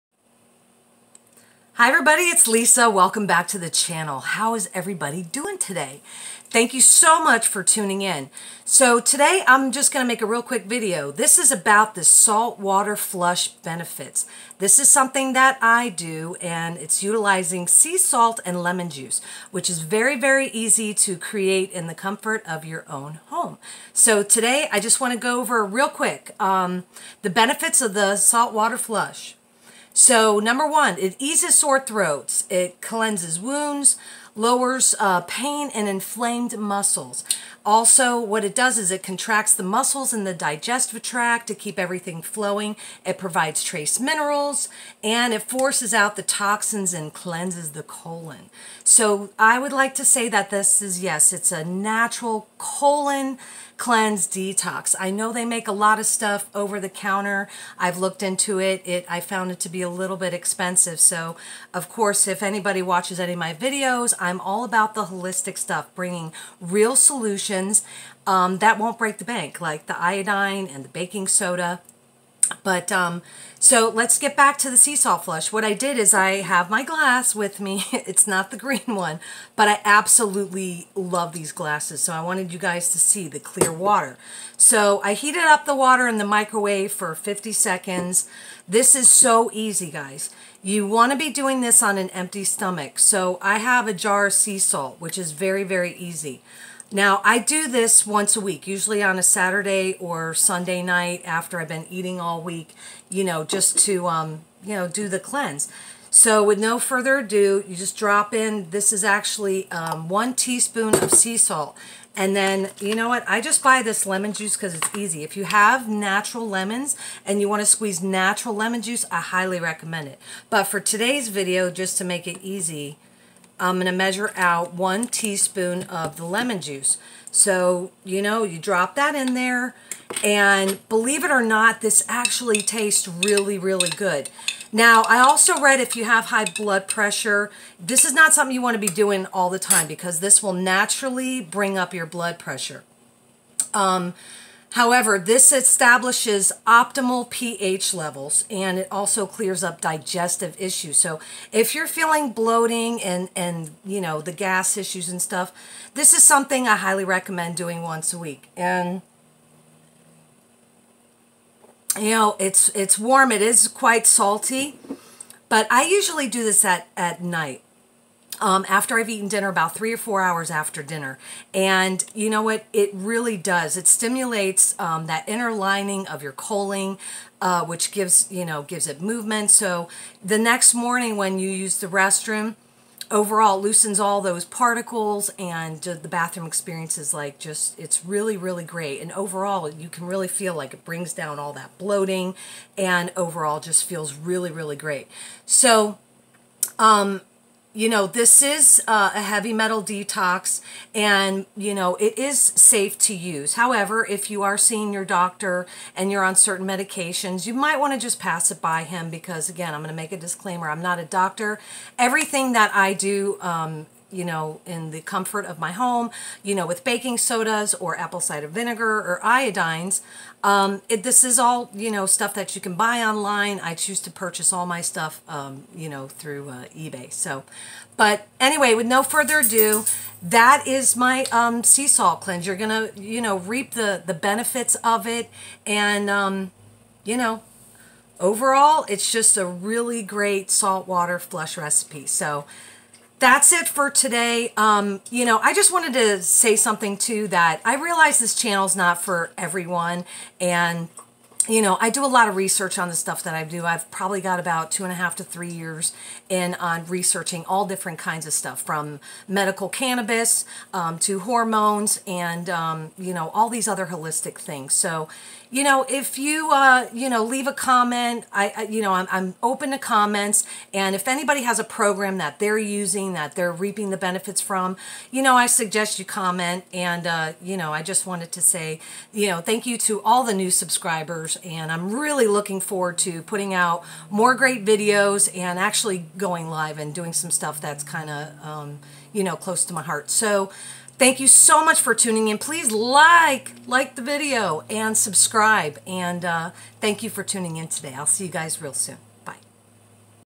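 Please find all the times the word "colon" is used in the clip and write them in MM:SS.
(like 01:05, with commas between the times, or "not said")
00:47, 00:52, 02:56.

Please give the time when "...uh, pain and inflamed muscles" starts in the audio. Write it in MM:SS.
00:34.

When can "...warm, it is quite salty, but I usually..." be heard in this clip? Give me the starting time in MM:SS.
02:42.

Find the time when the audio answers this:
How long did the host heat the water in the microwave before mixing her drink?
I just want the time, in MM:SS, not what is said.
01:27.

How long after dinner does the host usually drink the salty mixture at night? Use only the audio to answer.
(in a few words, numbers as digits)
3 or 4 hours.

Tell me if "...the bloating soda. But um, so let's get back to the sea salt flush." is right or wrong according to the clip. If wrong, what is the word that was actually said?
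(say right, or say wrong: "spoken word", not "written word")
wrong: "baking", not "bloating".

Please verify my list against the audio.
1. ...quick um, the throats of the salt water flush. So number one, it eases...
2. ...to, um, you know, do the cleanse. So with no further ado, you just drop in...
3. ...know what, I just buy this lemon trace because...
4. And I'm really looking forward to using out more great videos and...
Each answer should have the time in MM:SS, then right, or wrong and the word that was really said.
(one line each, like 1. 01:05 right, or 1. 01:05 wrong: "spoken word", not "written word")
1. 00:25 wrong: "benefits", not "throats"
2. 01:43 right
3. 01:52 wrong: "juice", not "trace"
4. 04:41 wrong: "putting", not "using".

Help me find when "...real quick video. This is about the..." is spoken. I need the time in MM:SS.
00:10.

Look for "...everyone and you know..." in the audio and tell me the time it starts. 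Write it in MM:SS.
04:09.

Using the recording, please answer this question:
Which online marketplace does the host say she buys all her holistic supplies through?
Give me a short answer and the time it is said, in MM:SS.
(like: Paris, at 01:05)
eBay, at 03:46.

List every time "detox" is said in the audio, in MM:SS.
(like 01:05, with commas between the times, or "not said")
00:54, 03:19.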